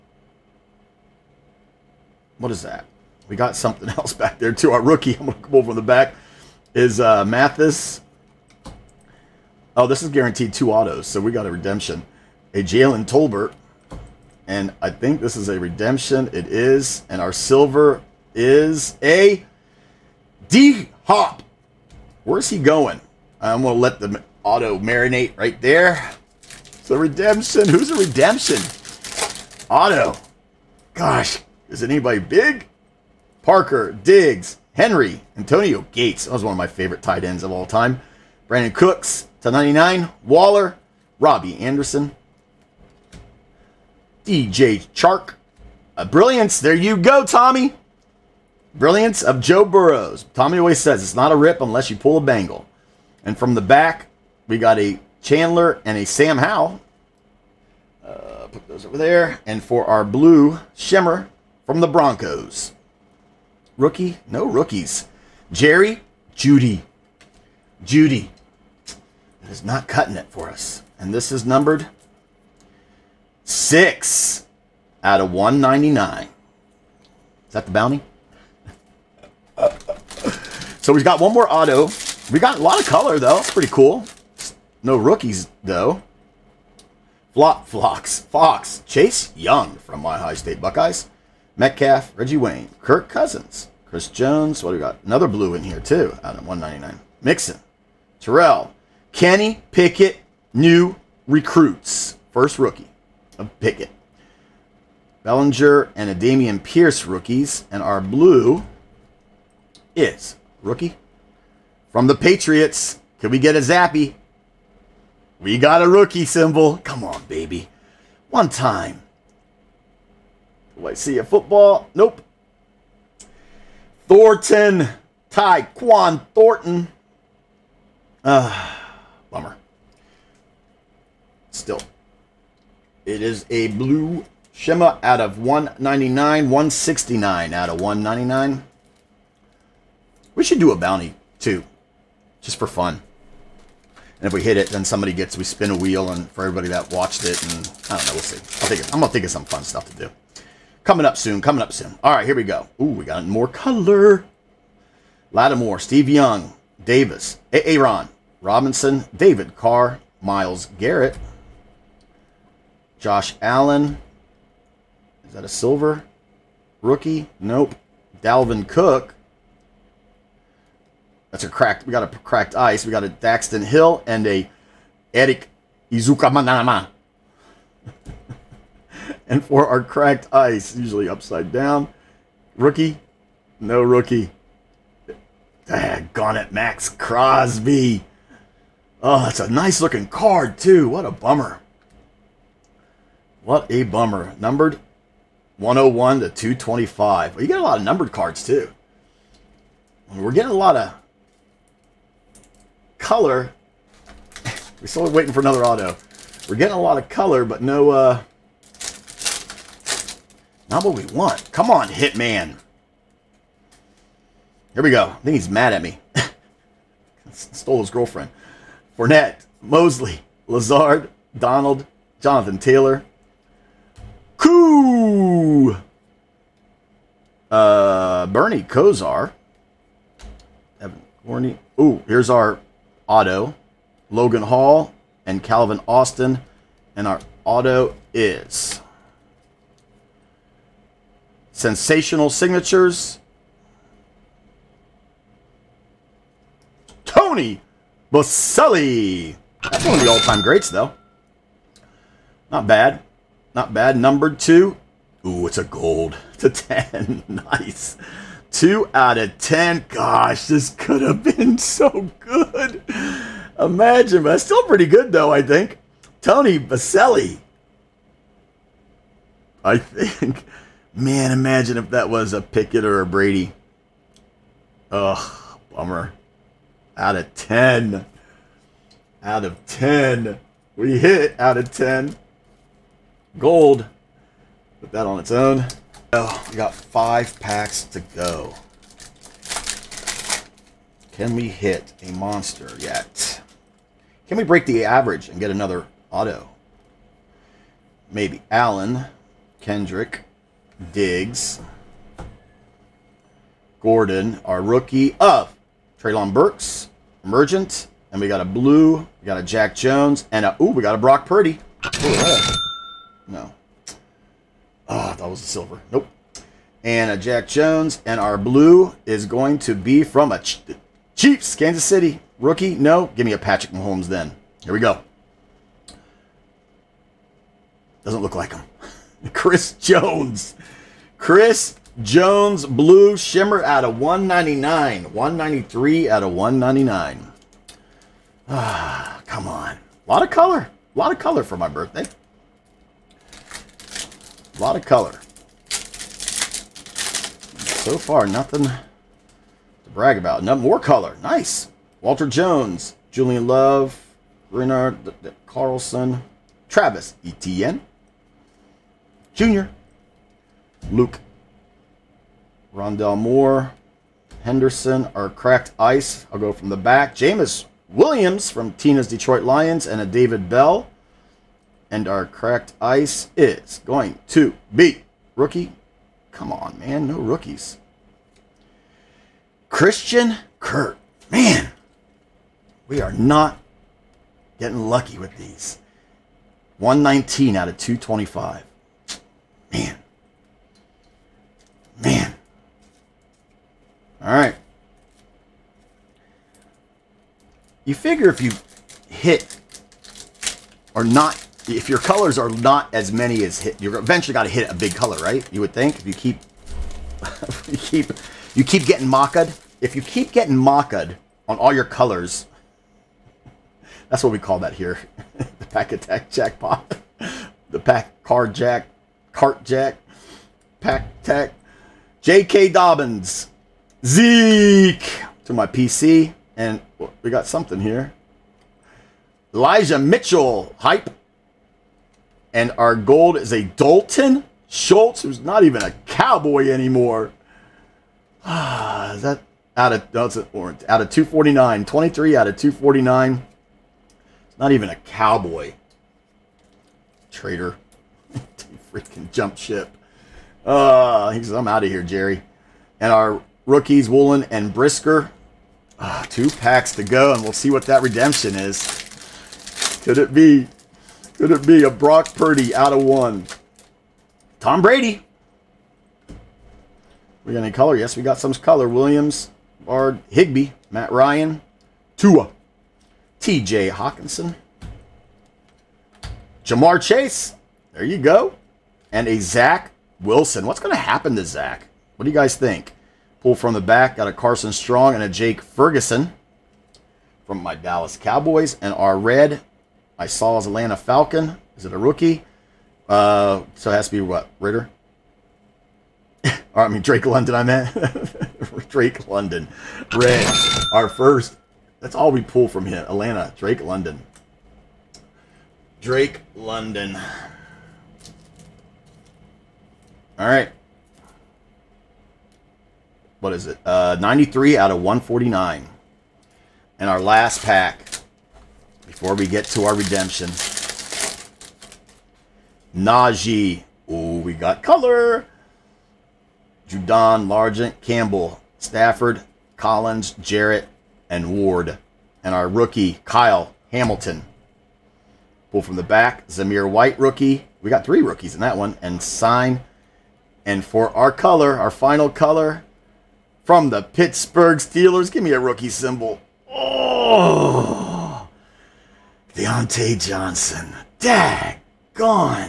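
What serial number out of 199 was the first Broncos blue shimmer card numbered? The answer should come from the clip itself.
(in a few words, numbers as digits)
6.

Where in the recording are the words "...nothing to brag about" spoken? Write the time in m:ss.
5:48.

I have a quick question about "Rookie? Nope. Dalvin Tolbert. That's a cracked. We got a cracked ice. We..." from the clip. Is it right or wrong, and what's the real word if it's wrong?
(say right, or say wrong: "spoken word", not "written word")
wrong: "Cook", not "Tolbert".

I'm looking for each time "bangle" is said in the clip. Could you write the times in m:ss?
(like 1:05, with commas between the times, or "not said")
0:52.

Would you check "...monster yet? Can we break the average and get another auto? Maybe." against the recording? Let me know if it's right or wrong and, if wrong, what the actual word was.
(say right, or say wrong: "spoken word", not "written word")
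right.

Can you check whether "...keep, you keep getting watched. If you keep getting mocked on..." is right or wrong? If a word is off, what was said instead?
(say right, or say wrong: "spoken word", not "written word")
wrong: "mocked", not "watched".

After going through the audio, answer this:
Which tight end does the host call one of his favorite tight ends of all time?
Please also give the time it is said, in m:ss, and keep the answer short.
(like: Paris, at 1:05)
Antonio Gates, at 0:35.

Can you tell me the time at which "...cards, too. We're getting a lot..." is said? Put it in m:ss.
3:18.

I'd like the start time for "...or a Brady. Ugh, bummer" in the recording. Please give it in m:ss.
4:32.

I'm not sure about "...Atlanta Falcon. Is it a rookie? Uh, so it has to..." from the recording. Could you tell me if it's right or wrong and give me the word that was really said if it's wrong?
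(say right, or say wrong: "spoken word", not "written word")
right.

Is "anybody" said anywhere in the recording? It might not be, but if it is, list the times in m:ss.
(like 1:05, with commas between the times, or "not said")
0:31.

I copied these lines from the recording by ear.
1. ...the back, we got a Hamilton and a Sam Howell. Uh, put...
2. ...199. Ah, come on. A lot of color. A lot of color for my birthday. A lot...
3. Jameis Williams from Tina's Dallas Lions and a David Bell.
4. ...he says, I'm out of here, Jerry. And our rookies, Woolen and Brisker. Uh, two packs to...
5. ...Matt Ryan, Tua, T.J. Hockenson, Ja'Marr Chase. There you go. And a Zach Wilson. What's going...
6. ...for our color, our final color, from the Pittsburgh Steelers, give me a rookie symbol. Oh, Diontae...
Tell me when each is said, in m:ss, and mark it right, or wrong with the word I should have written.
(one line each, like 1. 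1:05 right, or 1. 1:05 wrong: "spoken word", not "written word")
1. 0:53 wrong: "Chandler", not "Hamilton"
2. 5:36 right
3. 6:07 wrong: "Detroit", not "Dallas"
4. 7:31 right
5. 7:50 right
6. 9:00 right.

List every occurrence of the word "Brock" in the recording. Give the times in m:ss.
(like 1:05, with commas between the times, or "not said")
5:10, 7:41.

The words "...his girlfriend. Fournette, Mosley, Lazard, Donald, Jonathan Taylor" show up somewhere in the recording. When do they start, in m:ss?
3:37.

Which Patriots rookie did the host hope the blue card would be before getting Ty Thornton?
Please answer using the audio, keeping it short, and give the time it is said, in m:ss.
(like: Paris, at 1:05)
Zappe, at 1:53.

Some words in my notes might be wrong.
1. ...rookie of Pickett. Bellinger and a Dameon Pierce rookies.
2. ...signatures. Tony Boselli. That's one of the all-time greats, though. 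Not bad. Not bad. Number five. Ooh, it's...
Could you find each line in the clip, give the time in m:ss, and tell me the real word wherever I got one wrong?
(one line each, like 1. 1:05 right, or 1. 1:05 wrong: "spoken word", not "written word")
1. 1:42 right
2. 4:02 wrong: "two", not "five".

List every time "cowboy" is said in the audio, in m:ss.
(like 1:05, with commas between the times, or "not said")
7:16, 7:24, 8:08.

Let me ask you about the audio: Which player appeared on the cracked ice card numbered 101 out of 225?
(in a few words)
Max Crosby.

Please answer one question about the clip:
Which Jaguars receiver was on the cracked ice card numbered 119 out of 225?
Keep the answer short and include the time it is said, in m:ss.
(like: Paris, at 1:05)
Christian Kirk, at 6:19.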